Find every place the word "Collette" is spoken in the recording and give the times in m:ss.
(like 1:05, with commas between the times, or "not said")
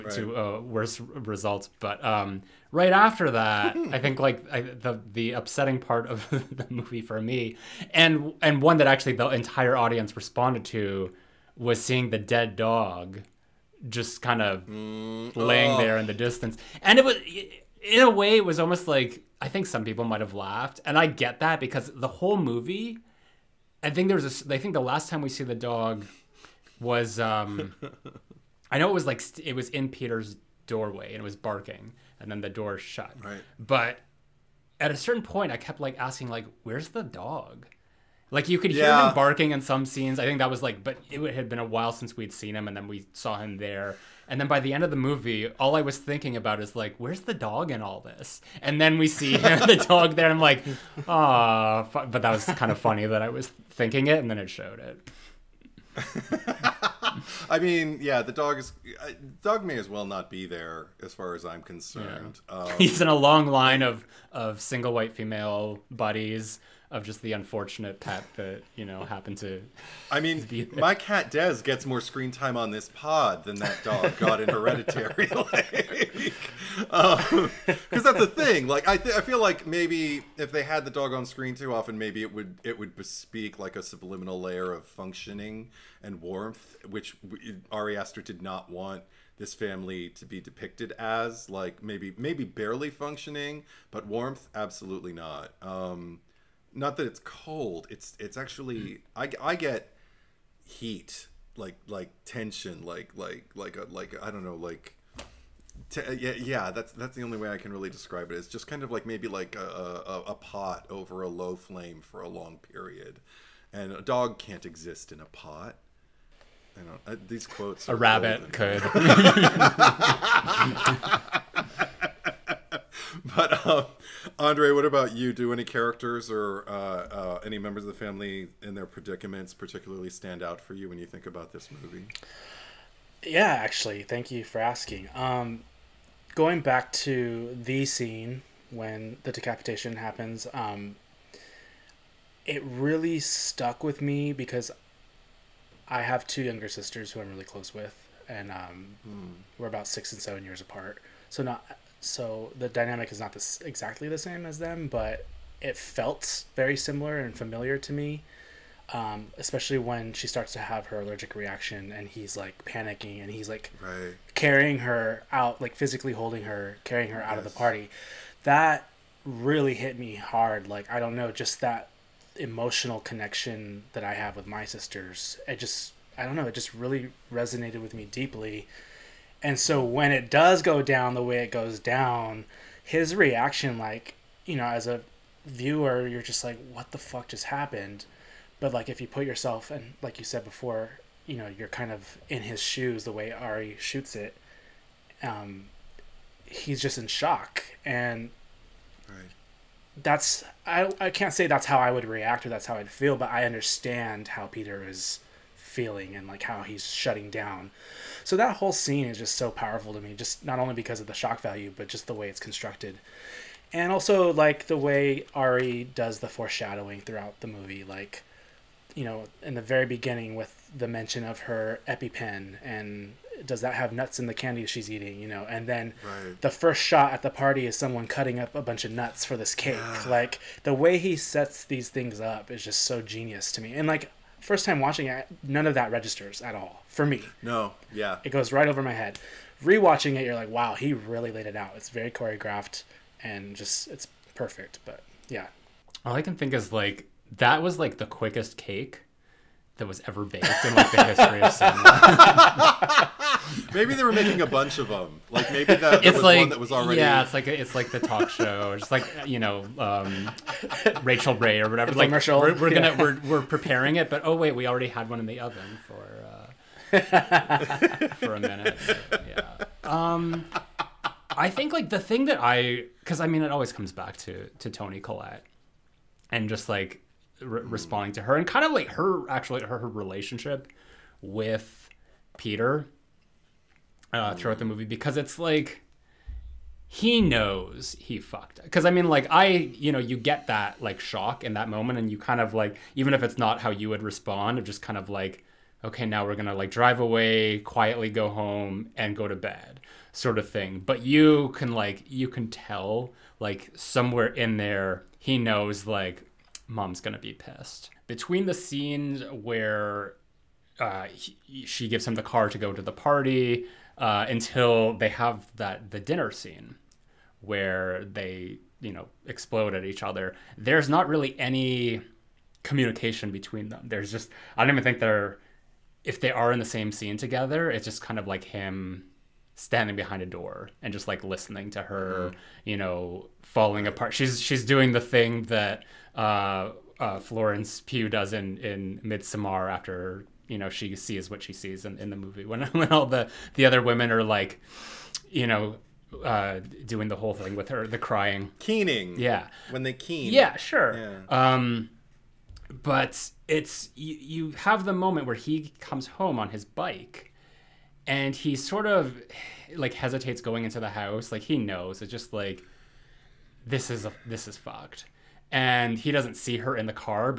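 4:35.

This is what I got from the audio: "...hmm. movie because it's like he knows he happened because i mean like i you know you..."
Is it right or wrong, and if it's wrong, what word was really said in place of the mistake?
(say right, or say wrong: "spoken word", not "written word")
wrong: "fucked", not "happened".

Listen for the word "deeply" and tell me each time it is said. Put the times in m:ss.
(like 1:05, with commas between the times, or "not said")
2:58.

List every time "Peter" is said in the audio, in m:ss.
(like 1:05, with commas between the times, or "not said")
0:29, 3:24, 4:42.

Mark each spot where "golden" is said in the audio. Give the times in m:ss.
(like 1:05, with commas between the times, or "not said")
1:58.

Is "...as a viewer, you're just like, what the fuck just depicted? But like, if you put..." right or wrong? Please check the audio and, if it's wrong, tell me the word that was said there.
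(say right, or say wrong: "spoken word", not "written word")
wrong: "happened", not "depicted".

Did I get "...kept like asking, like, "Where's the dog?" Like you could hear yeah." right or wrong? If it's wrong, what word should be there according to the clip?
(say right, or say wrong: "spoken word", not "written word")
right.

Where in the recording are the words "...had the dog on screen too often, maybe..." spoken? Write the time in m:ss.
1:20.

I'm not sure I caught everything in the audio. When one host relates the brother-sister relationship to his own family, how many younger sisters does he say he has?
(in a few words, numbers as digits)
2.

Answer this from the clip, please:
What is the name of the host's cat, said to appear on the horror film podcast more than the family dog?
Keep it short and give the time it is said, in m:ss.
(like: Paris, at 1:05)
Des, at 1:11.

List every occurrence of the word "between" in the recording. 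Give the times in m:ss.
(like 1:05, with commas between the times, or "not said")
5:08, 5:23.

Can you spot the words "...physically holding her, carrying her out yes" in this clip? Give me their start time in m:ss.
2:45.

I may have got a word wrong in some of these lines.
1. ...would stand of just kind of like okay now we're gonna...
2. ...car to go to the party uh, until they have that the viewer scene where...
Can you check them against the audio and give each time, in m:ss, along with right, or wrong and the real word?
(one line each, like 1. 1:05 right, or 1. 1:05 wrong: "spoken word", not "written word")
1. 4:53 wrong: "respond", not "stand"
2. 5:12 wrong: "dinner", not "viewer".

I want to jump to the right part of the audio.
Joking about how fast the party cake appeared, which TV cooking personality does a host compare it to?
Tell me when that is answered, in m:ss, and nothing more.
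4:21.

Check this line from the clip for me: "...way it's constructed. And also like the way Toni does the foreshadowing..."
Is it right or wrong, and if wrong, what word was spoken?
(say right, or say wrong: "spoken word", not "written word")
wrong: "Ari", not "Toni".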